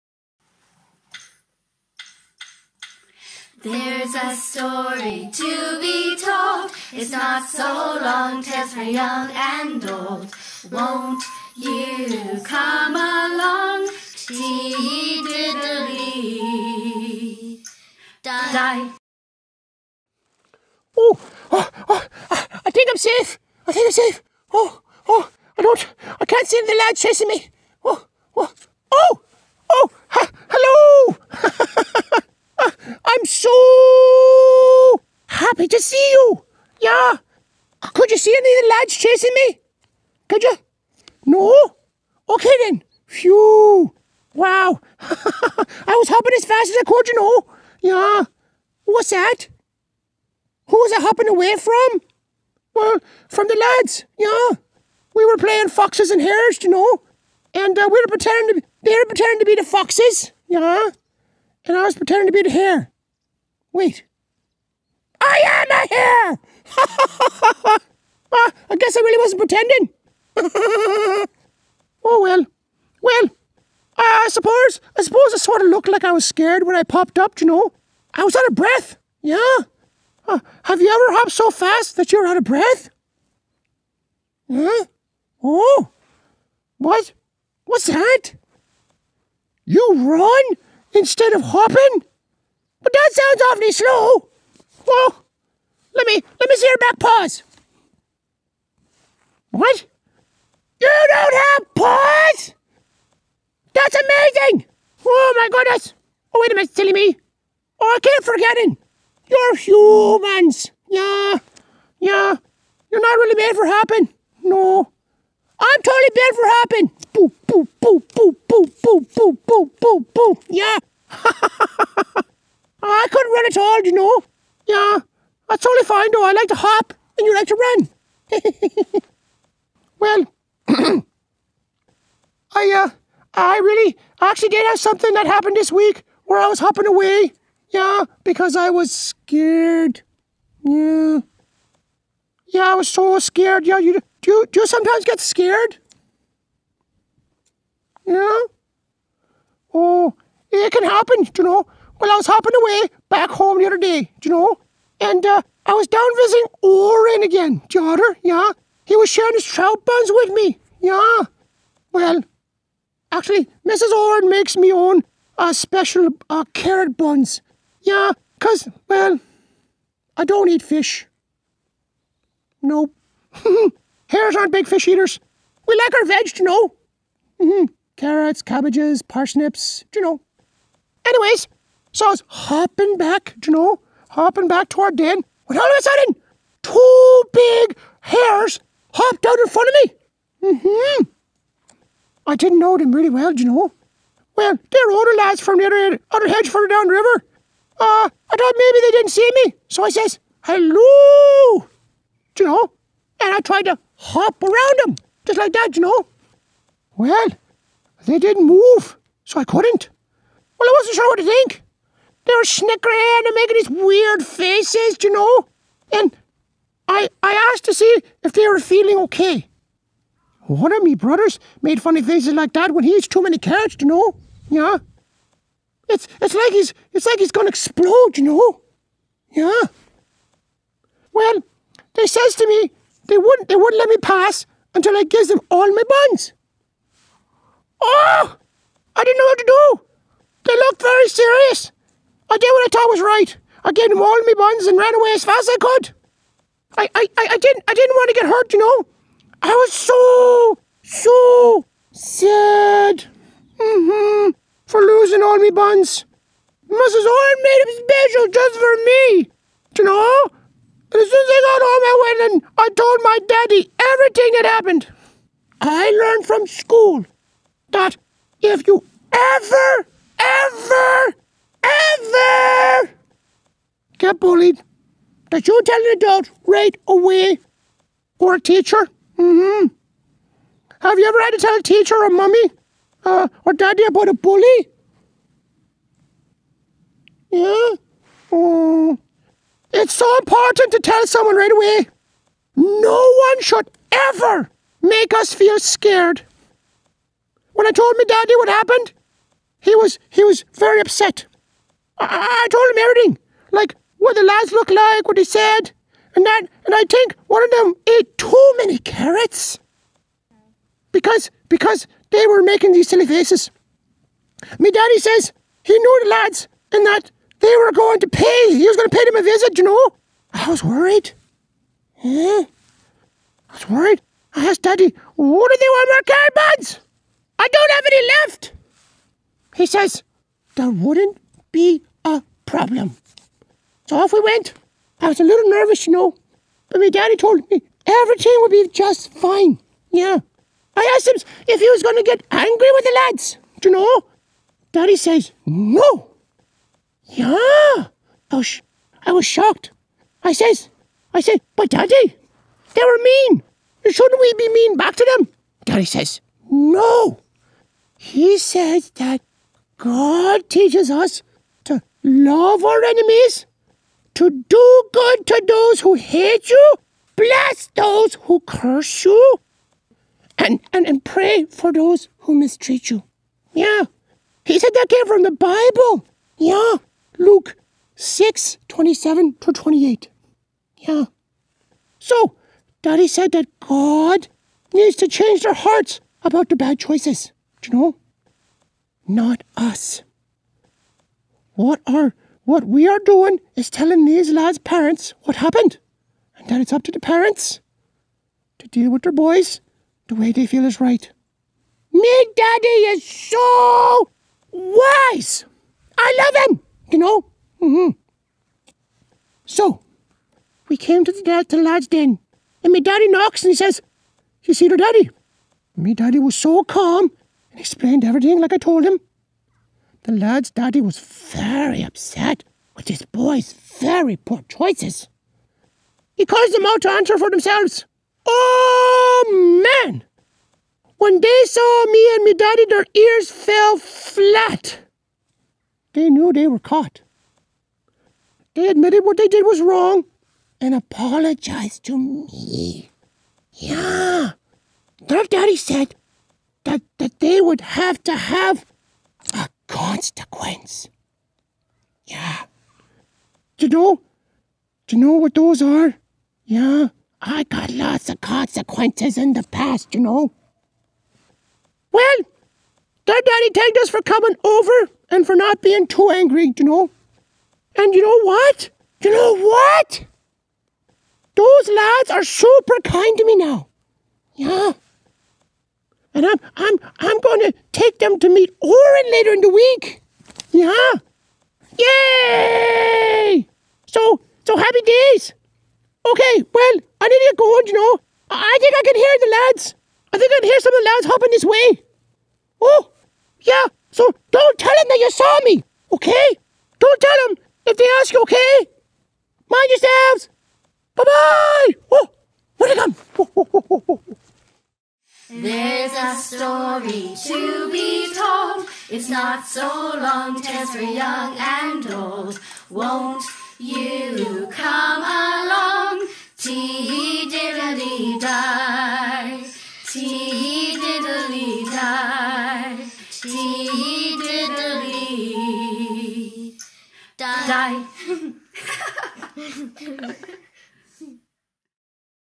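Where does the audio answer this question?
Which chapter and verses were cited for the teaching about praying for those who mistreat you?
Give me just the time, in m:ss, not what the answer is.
6:17.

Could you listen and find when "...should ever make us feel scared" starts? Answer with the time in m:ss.
4:53.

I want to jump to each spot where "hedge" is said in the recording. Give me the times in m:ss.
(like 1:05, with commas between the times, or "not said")
3:16.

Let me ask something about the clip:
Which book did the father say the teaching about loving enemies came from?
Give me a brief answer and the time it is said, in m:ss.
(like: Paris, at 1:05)
The Bible, at 6:15.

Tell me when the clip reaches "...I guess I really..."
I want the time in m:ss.
1:08.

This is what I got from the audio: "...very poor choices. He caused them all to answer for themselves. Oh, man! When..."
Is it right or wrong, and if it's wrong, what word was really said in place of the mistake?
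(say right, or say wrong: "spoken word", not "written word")
right.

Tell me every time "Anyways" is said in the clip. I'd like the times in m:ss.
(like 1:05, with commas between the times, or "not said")
3:01.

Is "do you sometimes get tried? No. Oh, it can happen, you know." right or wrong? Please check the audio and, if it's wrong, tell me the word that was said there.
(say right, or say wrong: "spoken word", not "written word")
wrong: "scared", not "tried".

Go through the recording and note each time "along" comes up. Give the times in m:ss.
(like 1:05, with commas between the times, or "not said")
0:12, 8:35.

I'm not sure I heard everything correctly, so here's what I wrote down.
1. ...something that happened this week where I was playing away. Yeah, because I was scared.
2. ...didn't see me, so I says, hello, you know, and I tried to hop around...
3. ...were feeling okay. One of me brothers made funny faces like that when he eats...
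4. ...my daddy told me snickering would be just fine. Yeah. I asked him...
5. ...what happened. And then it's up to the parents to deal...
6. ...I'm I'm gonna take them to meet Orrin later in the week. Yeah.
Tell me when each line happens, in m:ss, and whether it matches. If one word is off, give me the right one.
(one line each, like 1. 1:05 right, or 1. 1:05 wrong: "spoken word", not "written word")
1. 2:14 wrong: "hopping", not "playing"
2. 3:18 right
3. 3:38 right
4. 5:36 wrong: "everything", not "snickering"
5. 6:35 right
6. 7:56 right.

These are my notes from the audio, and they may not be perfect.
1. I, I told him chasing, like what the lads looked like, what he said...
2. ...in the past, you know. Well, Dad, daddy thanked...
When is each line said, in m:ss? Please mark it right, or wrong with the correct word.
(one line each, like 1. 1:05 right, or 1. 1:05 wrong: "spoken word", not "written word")
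1. 5:01 wrong: "everything", not "chasing"
2. 7:39 right.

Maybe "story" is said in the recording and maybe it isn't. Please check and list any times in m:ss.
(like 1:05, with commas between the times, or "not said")
0:04, 8:26.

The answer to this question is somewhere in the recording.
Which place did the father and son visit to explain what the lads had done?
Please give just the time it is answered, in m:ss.
6:51.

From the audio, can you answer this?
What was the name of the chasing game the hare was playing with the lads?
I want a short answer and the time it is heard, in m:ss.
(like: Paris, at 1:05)
Foxes and hares, at 0:55.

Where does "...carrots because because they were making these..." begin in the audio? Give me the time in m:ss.
5:08.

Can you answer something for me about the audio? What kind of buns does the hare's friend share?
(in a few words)
Trout buns.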